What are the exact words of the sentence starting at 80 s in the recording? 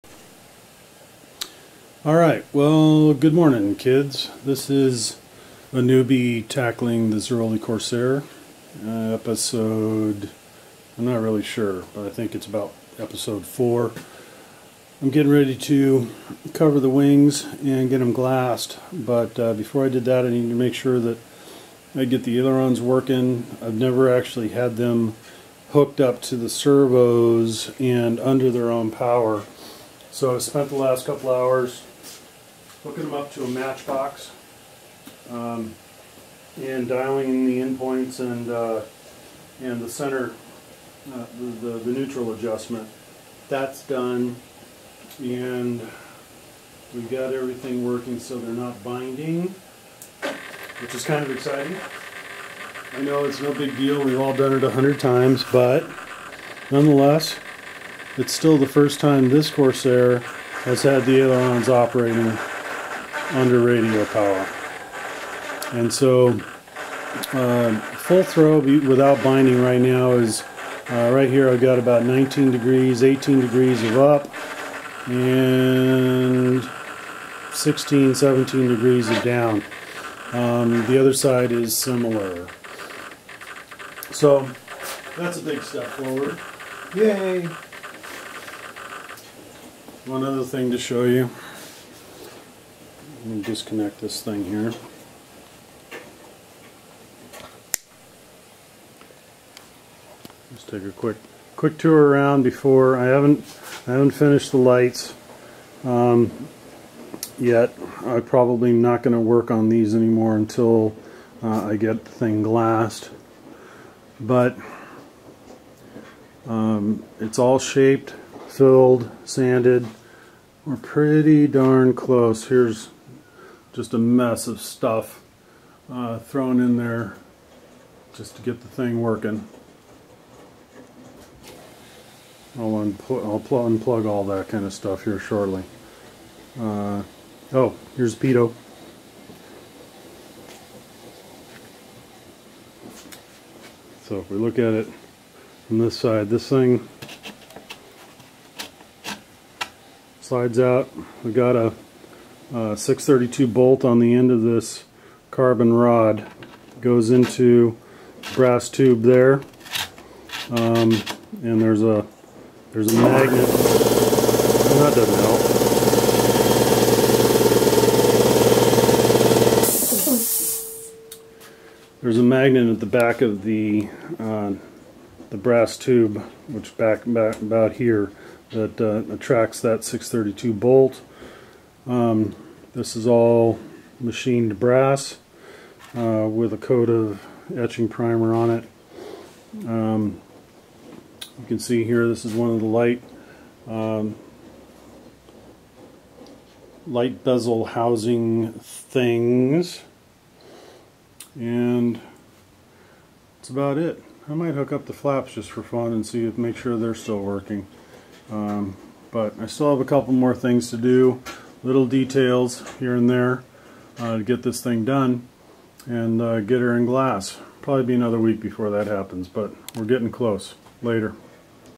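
Um, the other side is similar.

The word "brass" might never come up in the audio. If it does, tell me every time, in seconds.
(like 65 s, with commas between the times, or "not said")
158 s, 175 s, 184 s.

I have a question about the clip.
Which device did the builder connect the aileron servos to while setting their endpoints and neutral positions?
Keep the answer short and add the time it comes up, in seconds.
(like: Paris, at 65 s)
Matchbox, at 33 s.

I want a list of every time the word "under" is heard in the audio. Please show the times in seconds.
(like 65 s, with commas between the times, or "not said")
28 s, 63 s.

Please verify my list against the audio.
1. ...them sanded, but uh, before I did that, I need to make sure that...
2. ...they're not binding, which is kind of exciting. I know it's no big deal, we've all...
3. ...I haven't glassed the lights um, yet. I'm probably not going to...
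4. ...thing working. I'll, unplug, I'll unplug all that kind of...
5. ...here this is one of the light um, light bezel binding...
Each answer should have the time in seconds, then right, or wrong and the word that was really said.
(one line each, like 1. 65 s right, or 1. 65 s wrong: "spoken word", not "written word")
1. 17 s wrong: "glassed", not "sanded"
2. 48 s right
3. 103 s wrong: "finished", not "glassed"
4. 128 s right
5. 191 s wrong: "housing", not "binding".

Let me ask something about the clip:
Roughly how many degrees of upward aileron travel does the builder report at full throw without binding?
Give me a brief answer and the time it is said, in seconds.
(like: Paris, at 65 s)
19 degrees, at 72 s.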